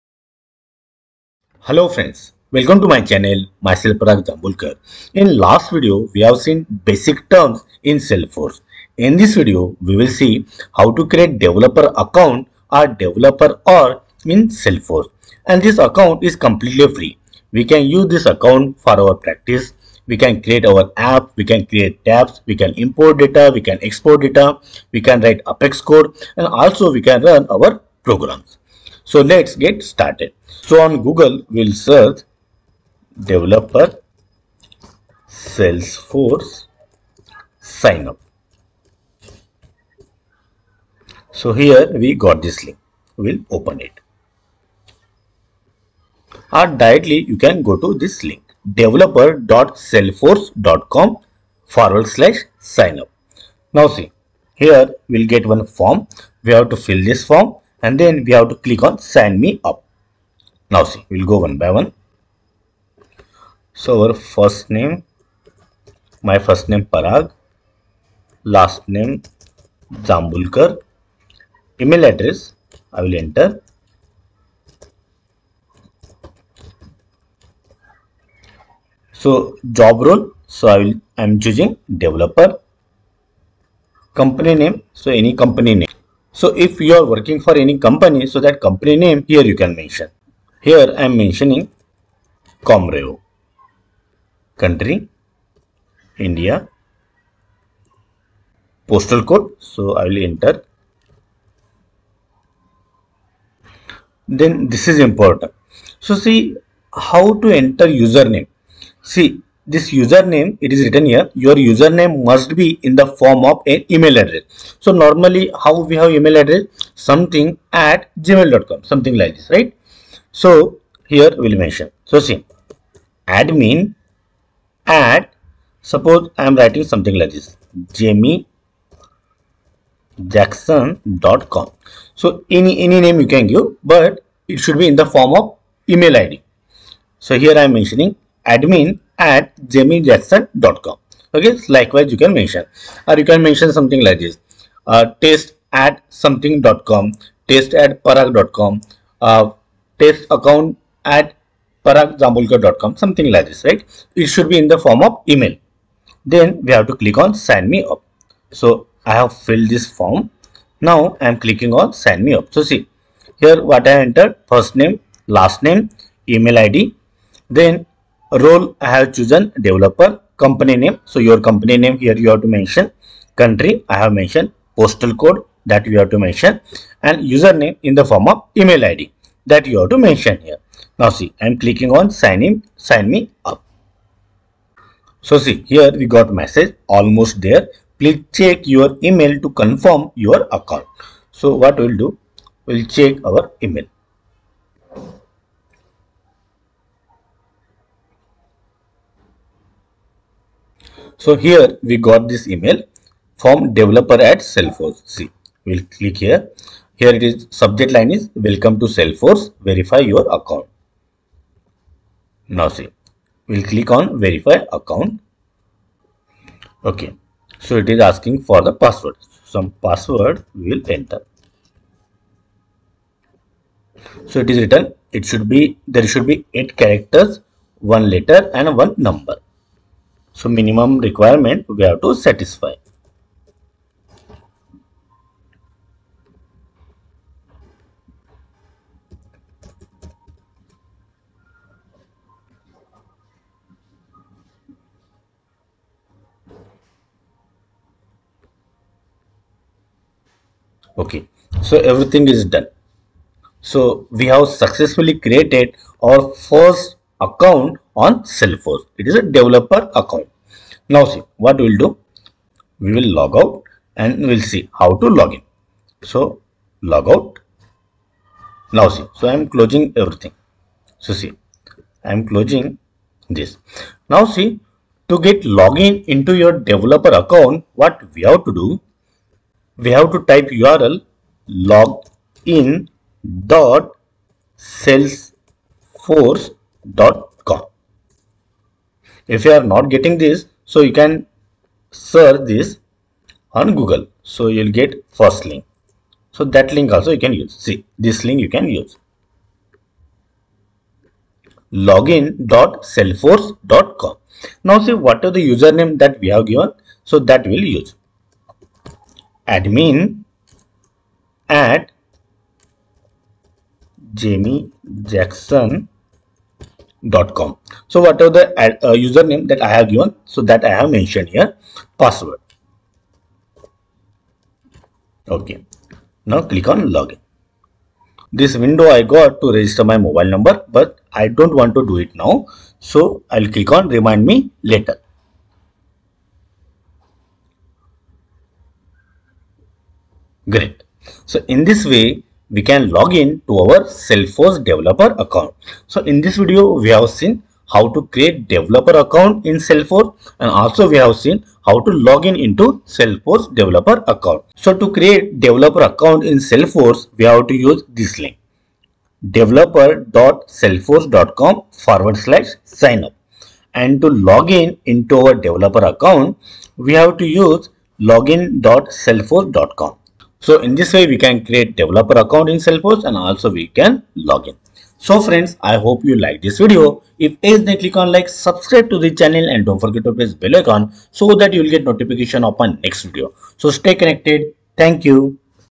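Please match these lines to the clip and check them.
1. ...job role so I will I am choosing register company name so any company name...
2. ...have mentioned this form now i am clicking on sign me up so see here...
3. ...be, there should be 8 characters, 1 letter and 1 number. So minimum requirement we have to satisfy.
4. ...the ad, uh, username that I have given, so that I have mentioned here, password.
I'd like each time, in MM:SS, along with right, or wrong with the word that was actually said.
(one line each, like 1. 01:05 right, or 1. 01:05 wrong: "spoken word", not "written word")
1. 01:19 wrong: "developer", not "register"
2. 02:39 wrong: "filled", not "mentioned"
3. 03:45 right
4. 05:18 right.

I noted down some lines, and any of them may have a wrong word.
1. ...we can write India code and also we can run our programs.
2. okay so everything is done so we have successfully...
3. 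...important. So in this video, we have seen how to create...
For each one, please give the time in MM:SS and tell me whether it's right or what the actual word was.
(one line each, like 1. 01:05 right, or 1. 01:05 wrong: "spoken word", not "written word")
1. 00:24 wrong: "Apex", not "India"
2. 04:10 right
3. 05:45 wrong: "account", not "important".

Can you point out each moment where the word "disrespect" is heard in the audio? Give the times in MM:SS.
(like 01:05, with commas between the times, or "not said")
not said.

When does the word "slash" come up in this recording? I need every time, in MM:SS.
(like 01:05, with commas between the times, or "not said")
00:52, 06:02.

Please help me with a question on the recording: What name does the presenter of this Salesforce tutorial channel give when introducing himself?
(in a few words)
Parag Jambulkar.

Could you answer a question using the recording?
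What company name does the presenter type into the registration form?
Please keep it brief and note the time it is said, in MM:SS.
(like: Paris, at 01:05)
Comrevo, at 01:32.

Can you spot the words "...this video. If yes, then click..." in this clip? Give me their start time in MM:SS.
06:16.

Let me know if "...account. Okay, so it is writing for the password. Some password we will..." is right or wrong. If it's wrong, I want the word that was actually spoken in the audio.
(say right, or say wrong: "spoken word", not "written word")
wrong: "asking", not "writing".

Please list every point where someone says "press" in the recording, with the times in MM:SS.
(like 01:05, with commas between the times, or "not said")
06:20.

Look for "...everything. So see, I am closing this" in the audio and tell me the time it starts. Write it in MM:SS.
04:29.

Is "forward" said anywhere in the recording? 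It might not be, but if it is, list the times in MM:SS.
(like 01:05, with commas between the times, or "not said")
00:51, 06:01.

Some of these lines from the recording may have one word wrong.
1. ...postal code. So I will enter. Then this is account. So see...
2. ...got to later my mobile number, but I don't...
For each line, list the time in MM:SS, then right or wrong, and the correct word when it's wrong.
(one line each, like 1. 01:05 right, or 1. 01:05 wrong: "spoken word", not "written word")
1. 01:38 wrong: "important", not "account"
2. 05:29 wrong: "register", not "later".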